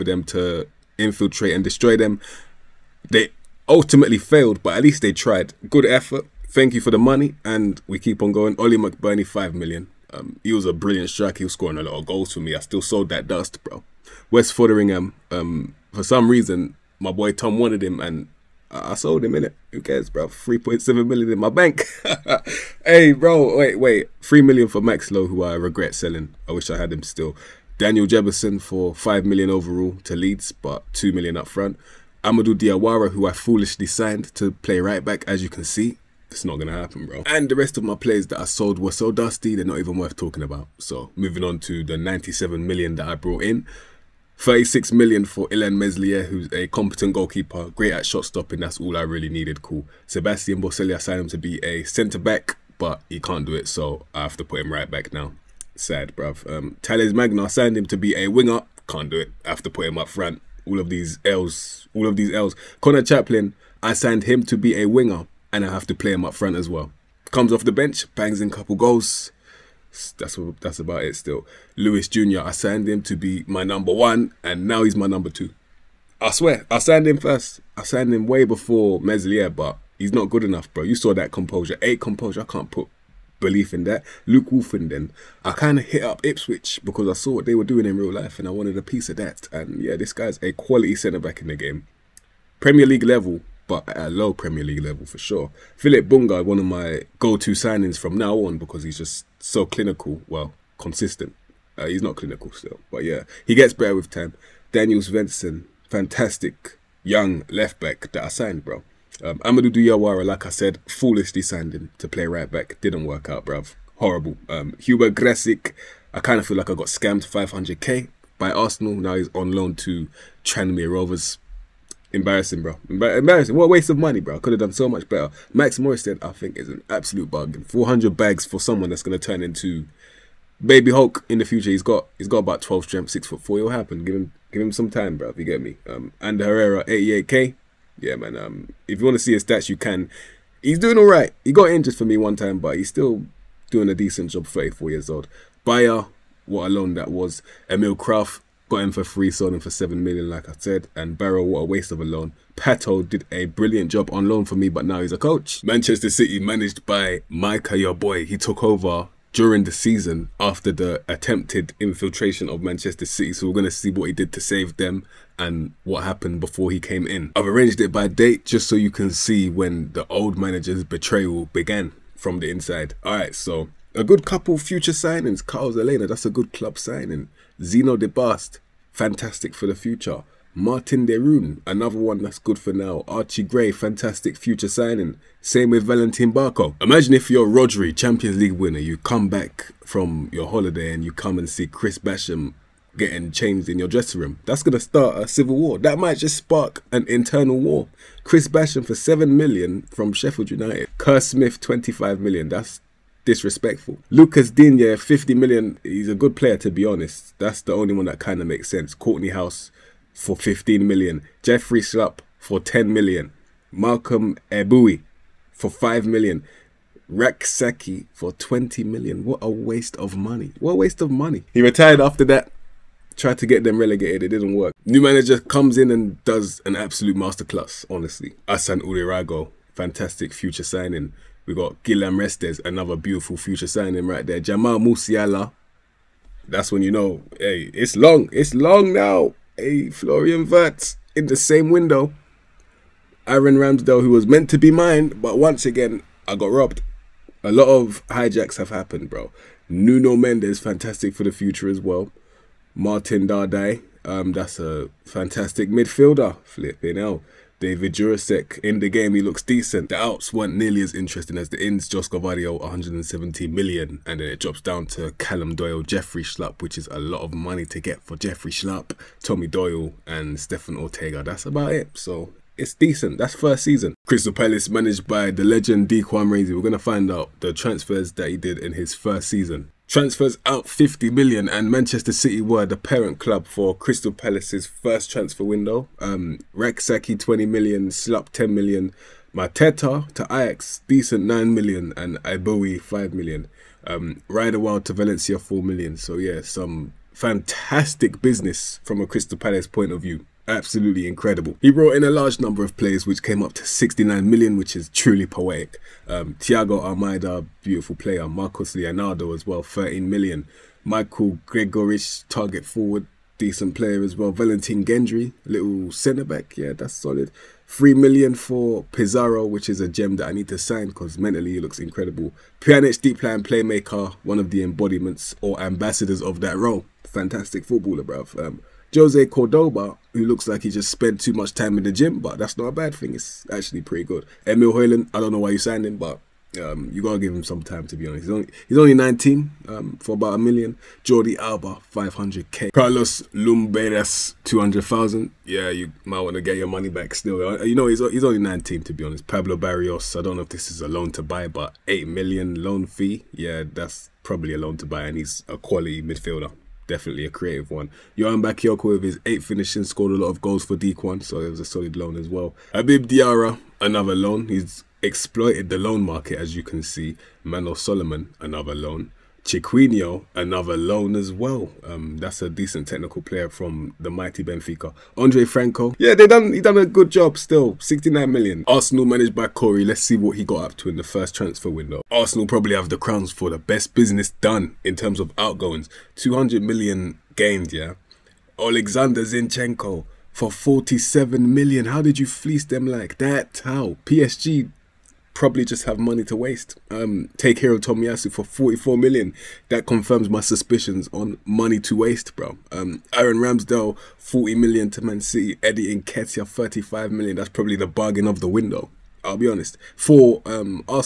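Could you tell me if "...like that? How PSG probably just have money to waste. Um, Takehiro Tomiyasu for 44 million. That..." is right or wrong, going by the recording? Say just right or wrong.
right.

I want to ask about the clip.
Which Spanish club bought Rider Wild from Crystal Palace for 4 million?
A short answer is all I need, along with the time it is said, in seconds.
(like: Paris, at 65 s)
Valencia, at 294 s.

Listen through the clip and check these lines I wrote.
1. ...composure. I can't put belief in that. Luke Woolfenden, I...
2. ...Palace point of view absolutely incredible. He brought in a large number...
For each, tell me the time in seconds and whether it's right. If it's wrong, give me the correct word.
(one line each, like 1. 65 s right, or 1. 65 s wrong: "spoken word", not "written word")
1. 81 s right
2. 299 s right.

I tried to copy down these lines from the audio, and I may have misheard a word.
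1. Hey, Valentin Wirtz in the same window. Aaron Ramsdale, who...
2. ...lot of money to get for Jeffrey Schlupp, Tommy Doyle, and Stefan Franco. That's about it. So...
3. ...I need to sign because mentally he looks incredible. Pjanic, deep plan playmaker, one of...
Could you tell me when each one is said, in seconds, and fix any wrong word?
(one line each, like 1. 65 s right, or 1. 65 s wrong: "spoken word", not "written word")
1. 239 s wrong: "Florian", not "Valentin"
2. 266 s wrong: "Ortega", not "Franco"
3. 320 s right.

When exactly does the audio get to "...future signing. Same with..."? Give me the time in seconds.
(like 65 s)
184 s.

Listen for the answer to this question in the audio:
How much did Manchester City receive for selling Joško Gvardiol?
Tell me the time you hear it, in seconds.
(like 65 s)
262 s.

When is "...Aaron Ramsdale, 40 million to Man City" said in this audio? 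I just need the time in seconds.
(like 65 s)
403 s.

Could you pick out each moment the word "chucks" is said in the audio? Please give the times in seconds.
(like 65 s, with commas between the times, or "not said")
not said.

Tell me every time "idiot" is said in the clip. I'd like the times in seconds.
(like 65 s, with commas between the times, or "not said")
not said.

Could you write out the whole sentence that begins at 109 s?
Um, Amadou Diawara, like I said, foolishly signed him to play right back.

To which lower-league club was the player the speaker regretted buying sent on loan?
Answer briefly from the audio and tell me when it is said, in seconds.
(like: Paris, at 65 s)
Tranmere Rovers, at 120 s.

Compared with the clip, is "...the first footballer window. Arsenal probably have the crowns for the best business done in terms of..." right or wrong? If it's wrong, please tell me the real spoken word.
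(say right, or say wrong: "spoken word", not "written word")
wrong: "transfer", not "footballer".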